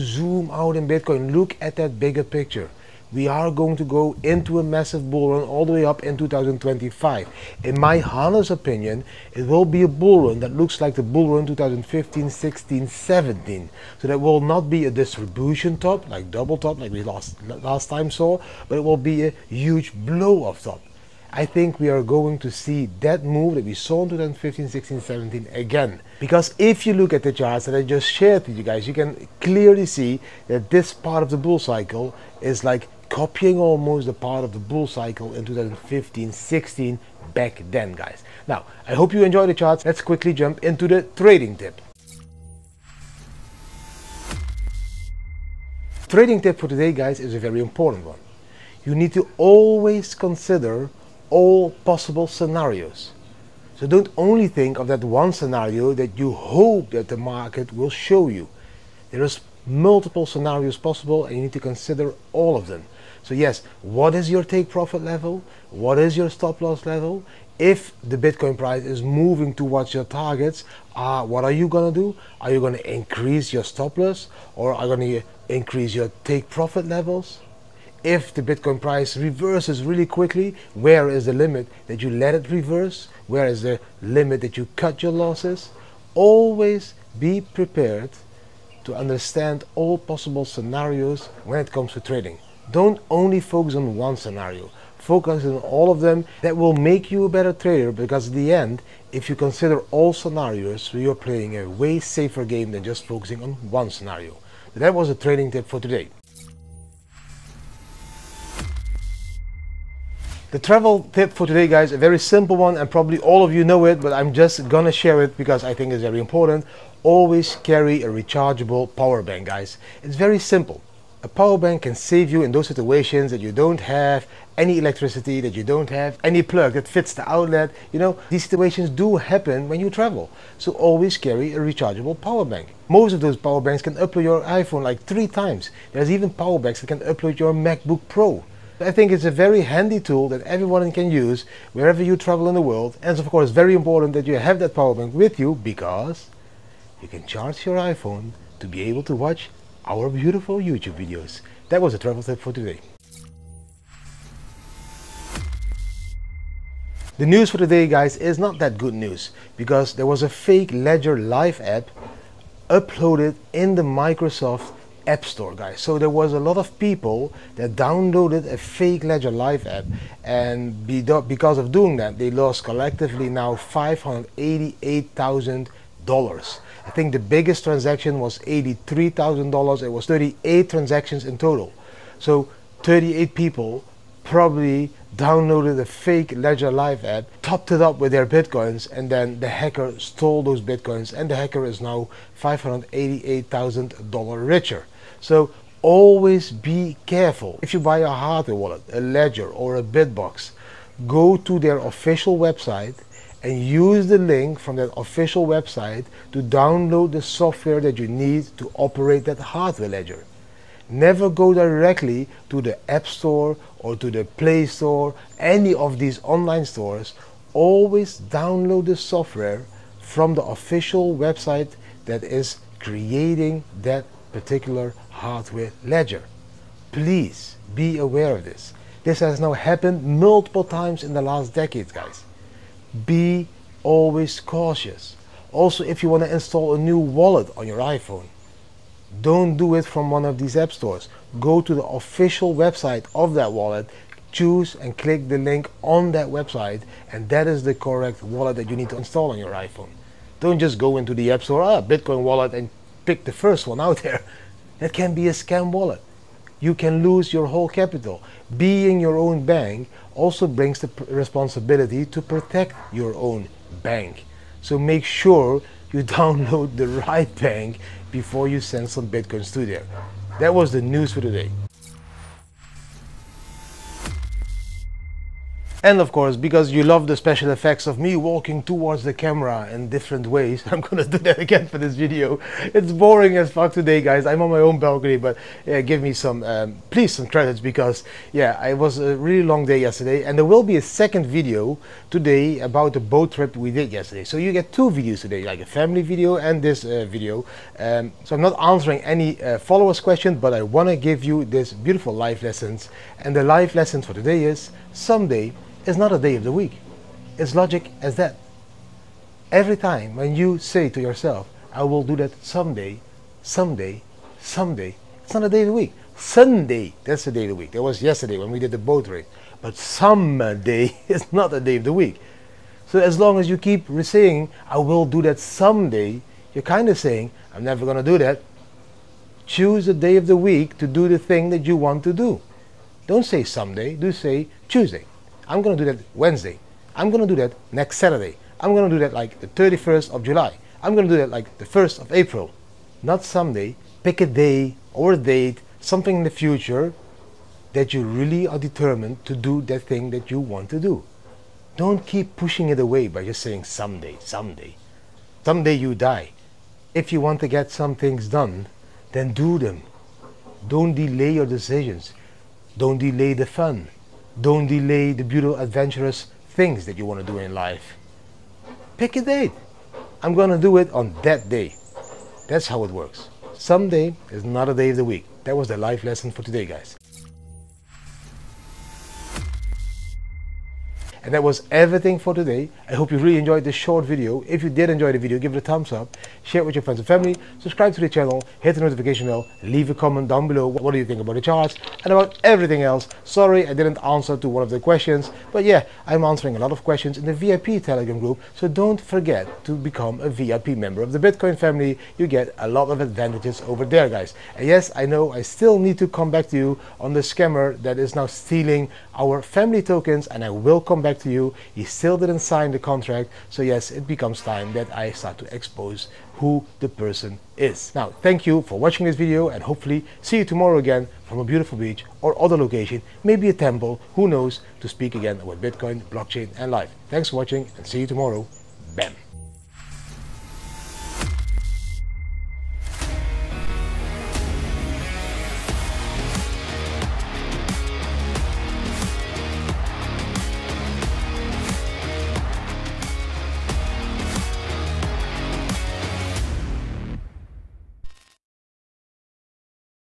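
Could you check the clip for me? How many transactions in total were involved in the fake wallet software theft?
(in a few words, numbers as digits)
38.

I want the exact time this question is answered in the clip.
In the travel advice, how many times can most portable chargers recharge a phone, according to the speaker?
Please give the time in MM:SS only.
02:15.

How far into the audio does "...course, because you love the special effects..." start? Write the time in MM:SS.
04:36.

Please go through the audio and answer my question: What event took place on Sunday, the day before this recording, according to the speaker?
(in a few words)
Boat race.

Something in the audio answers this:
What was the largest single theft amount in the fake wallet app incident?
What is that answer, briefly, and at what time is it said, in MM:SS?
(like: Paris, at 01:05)
$83,000, at 02:58.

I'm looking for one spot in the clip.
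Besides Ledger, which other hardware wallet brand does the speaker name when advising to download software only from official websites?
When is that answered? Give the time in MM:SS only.
03:19.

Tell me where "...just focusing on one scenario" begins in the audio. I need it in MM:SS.
01:42.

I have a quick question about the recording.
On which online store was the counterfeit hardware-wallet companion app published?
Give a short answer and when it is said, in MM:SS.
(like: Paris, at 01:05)
Microsoft App Store, at 02:43.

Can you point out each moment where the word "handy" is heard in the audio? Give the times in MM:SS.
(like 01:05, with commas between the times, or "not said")
02:19.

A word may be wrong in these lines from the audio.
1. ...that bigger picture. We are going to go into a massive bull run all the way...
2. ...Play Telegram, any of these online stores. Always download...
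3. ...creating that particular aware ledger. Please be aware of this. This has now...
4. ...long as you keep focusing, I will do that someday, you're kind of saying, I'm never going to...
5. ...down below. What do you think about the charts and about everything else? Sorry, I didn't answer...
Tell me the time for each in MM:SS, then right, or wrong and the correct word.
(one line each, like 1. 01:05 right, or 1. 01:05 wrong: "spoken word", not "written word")
1. 00:01 right
2. 03:34 wrong: "Store", not "Telegram"
3. 03:42 wrong: "hardware", not "aware"
4. 05:23 wrong: "saying", not "focusing"
5. 06:30 right.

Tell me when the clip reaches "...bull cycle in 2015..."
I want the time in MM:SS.
00:34.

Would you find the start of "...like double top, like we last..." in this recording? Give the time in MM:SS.
00:16.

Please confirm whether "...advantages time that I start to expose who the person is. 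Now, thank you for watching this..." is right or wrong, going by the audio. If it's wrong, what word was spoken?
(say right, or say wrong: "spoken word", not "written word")
wrong: "becomes", not "advantages".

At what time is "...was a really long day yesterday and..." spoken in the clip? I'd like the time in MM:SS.
04:48.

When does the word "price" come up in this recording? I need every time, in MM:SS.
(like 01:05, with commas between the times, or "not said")
01:08, 01:18.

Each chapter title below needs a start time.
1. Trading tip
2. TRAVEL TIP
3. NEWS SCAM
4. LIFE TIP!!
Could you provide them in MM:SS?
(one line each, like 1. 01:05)
1. 00:41
2. 01:46
3. 02:32
4. 04:33.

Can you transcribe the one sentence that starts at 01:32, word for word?
Don't only focus on one scenario.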